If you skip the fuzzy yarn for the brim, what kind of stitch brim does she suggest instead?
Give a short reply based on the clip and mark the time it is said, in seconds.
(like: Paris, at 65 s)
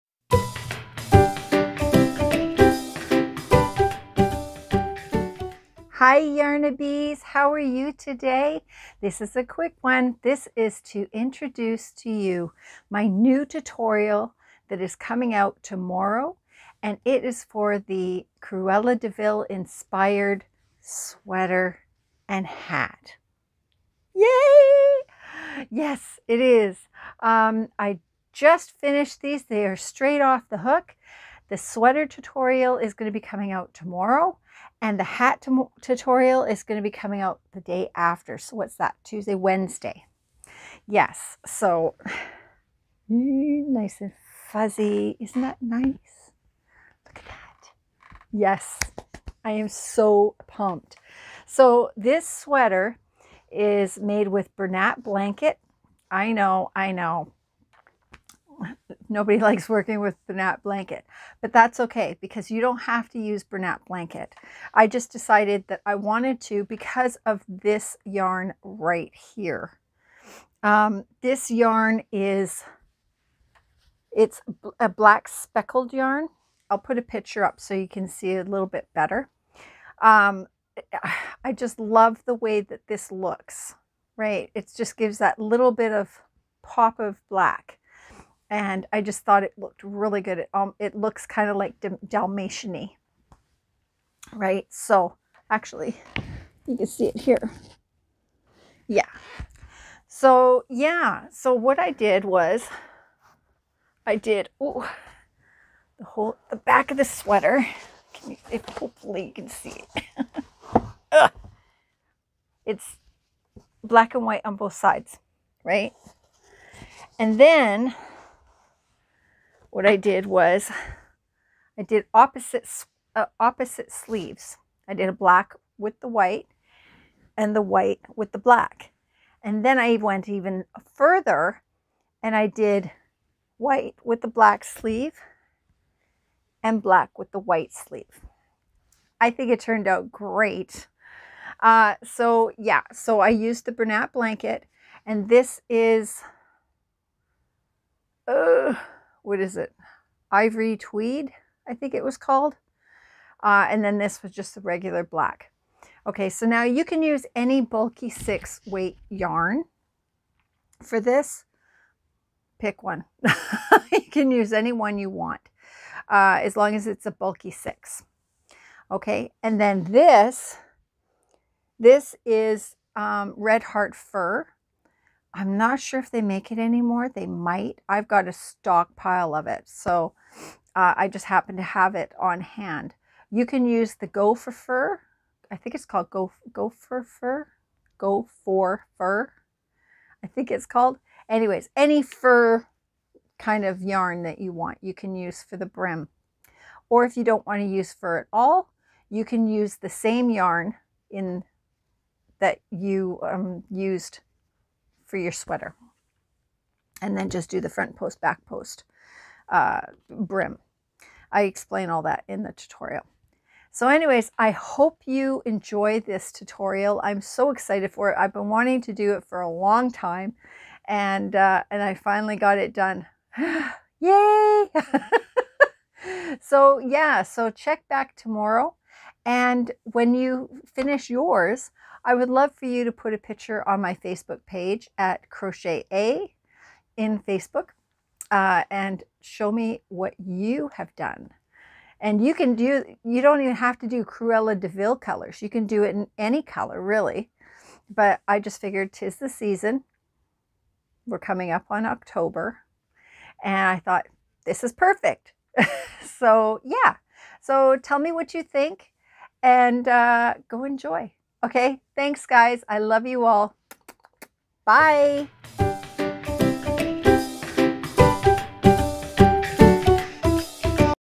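front post, back post, at 207 s.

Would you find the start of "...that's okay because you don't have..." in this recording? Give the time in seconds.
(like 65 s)
61 s.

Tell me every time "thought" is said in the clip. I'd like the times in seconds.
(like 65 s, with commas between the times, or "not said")
89 s, 253 s.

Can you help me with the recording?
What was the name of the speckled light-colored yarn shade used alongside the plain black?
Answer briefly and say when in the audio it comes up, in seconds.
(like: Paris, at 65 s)
Ivory Tweed, at 150 s.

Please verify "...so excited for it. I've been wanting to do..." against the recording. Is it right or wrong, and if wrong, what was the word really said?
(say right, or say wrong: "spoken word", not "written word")
right.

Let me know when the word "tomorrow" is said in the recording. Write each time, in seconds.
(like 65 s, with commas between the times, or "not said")
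15 s, 33 s, 228 s.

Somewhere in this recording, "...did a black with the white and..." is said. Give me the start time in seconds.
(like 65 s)
124 s.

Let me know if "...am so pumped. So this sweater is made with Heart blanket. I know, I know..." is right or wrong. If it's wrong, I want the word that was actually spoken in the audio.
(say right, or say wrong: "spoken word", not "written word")
wrong: "Bernat", not "Heart".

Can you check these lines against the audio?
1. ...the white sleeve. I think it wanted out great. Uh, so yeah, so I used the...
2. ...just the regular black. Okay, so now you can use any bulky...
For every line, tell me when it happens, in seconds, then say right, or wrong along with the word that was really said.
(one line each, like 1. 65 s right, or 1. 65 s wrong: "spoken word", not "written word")
1. 137 s wrong: "turned", not "wanted"
2. 154 s right.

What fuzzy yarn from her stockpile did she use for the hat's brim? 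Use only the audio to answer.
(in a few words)
Red Heart Fur.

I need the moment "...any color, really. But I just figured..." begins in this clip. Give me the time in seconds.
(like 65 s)
246 s.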